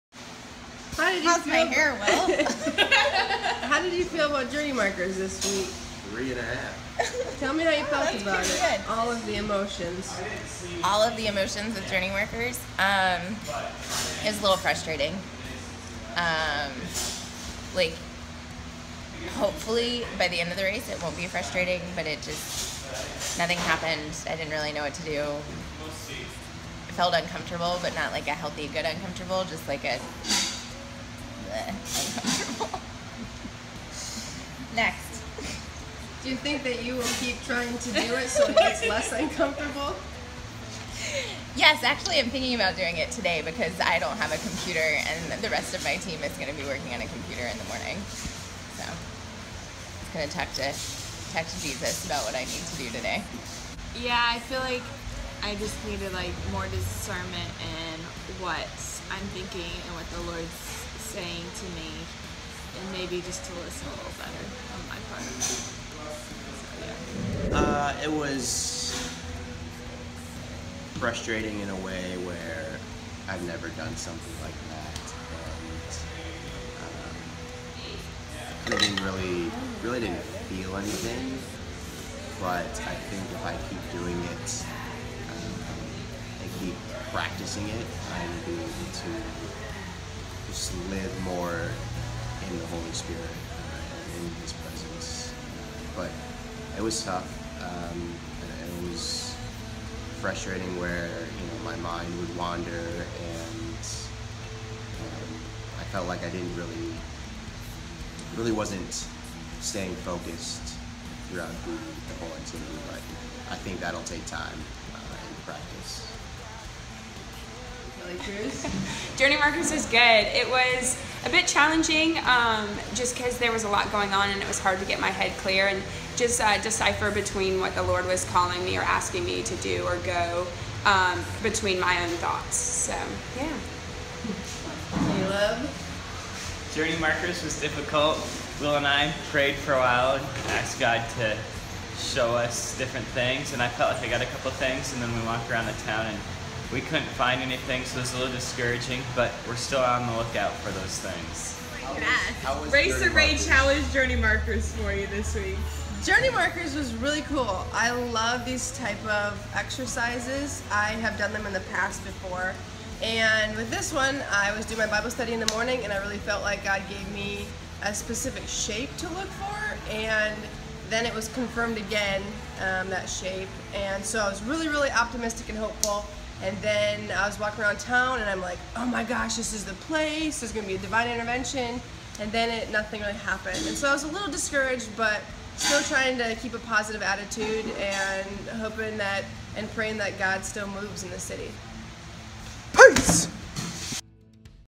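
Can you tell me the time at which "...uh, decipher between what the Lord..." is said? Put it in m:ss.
2:06.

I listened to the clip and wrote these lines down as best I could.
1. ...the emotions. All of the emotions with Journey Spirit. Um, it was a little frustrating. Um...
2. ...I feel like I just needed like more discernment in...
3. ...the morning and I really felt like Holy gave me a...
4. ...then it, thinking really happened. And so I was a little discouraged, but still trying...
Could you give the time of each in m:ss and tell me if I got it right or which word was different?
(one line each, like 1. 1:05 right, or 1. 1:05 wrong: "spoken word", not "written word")
1. 0:09 wrong: "Markers", not "Spirit"
2. 0:54 right
3. 2:45 wrong: "God", not "Holy"
4. 3:02 wrong: "nothing", not "thinking".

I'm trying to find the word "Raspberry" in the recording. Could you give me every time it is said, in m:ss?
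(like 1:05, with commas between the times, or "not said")
not said.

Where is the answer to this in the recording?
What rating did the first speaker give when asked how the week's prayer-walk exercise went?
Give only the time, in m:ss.
0:06.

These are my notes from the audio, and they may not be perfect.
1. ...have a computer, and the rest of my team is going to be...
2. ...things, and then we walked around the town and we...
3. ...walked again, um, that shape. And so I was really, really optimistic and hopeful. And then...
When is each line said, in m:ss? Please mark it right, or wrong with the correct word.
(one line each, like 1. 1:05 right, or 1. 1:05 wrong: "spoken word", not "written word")
1. 0:44 right
2. 2:24 right
3. 2:51 wrong: "confirmed", not "walked".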